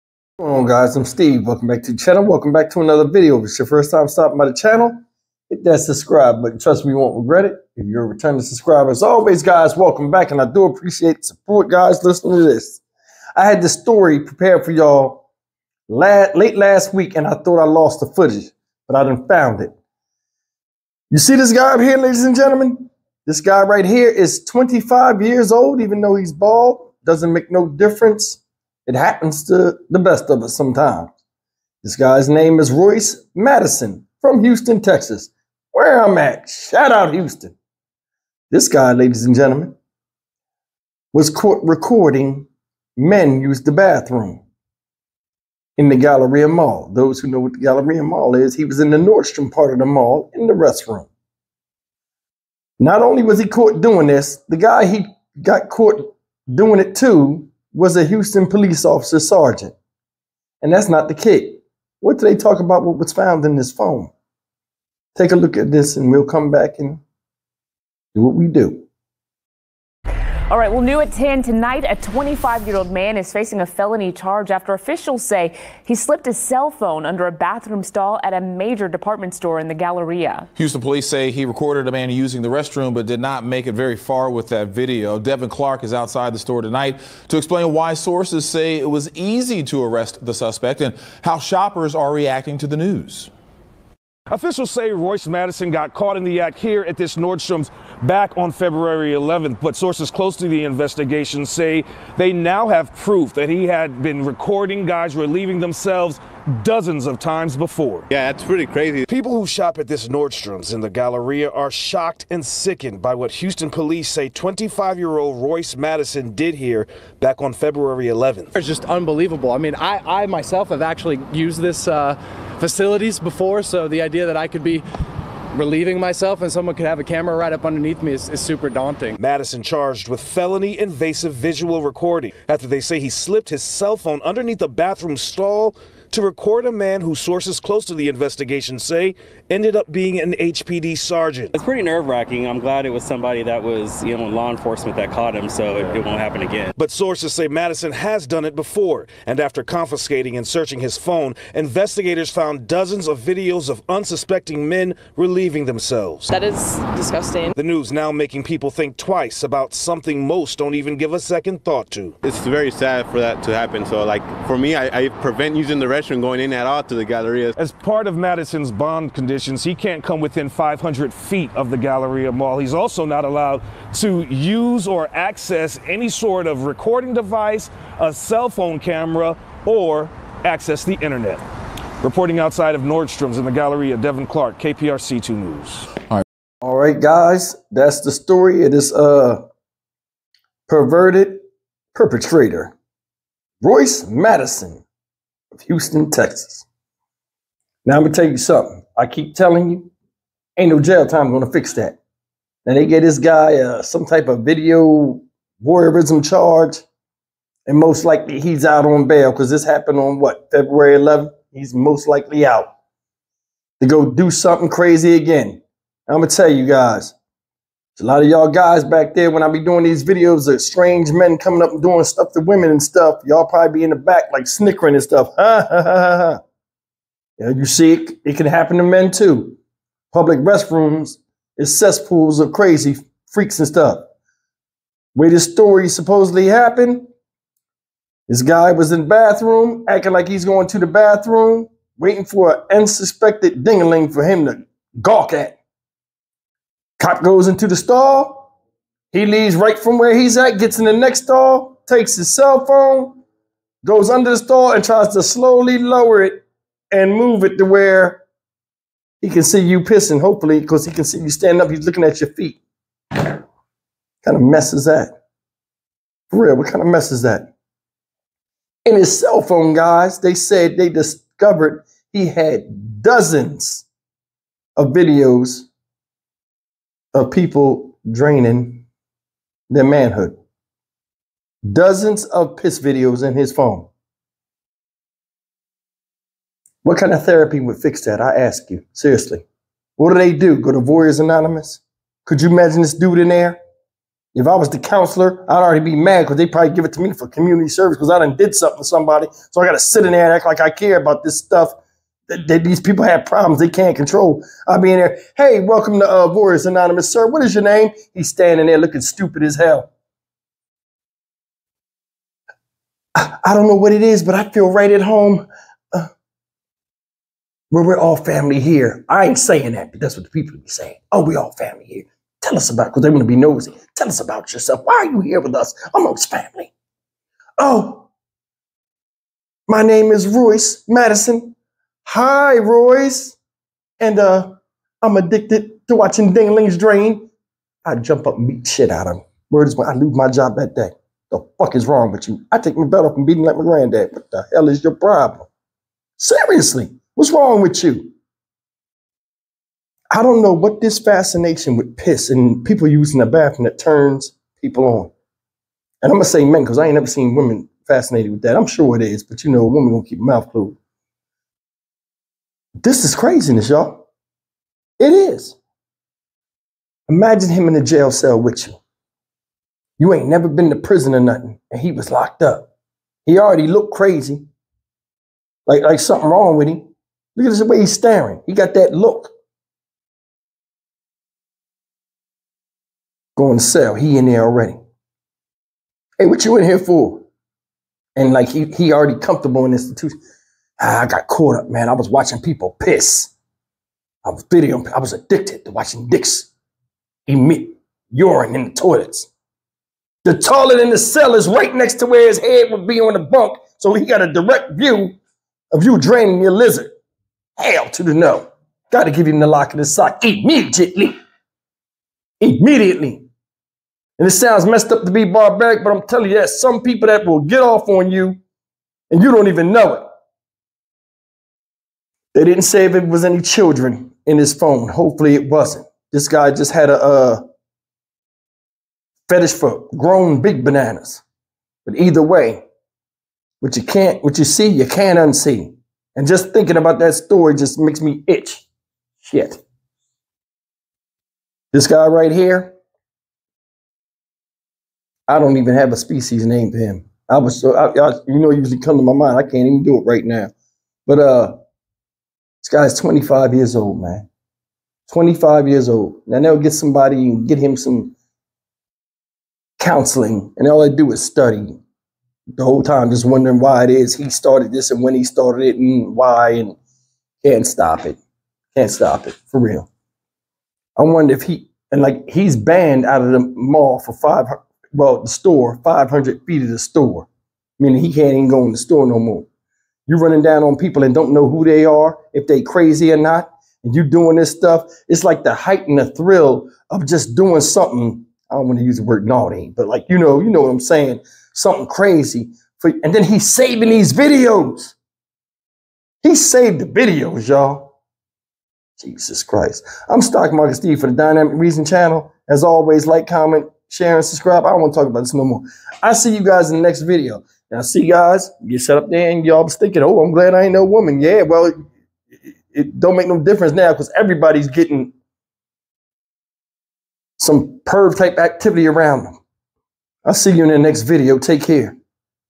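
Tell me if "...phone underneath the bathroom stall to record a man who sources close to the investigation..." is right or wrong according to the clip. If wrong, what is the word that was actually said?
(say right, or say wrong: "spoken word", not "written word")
right.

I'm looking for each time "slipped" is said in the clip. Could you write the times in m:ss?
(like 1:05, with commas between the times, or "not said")
1:15, 2:13.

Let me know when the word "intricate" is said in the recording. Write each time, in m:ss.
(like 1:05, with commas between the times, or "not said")
not said.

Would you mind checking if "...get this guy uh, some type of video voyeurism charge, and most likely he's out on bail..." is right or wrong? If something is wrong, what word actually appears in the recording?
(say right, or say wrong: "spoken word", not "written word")
right.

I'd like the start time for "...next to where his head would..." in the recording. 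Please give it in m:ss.
6:41.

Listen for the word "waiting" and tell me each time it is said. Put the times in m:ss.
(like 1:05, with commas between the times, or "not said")
4:01.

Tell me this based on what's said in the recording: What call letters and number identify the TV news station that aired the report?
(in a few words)
KPRC 2.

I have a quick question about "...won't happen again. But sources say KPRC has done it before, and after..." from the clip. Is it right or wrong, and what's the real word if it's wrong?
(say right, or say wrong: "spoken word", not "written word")
wrong: "Madison", not "KPRC".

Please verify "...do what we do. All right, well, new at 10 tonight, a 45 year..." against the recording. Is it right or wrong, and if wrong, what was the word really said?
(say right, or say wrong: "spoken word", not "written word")
wrong: "25", not "45".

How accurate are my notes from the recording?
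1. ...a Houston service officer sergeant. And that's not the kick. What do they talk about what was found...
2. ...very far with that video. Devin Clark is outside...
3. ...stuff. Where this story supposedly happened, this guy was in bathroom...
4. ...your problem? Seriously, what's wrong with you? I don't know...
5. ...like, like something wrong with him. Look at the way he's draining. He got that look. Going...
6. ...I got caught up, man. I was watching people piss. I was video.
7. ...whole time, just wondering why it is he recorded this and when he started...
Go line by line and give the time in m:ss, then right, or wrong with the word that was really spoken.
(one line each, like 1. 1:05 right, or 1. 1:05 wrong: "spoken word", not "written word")
1. 0:57 wrong: "police", not "service"
2. 1:23 right
3. 3:53 right
4. 5:44 right
5. 6:15 wrong: "staring", not "draining"
6. 6:31 right
7. 7:42 wrong: "started", not "recorded".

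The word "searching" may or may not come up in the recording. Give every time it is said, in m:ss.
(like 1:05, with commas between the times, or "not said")
2:30.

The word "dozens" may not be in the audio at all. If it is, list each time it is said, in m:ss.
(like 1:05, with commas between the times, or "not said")
1:46, 2:32, 4:33, 4:41.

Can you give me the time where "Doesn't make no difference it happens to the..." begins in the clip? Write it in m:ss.
0:27.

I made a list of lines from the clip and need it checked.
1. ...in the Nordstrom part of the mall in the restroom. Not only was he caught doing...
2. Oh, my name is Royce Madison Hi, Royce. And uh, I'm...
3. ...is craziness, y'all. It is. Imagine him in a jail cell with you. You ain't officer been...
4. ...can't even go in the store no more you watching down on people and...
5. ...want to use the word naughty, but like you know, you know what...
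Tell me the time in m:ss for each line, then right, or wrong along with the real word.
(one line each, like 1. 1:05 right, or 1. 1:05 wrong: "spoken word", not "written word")
1. 0:48 right
2. 5:27 right
3. 6:03 wrong: "never", not "officer"
4. 7:58 wrong: "running", not "watching"
5. 8:08 right.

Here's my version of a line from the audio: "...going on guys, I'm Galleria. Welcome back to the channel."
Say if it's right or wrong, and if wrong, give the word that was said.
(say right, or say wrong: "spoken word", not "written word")
wrong: "Steve", not "Galleria".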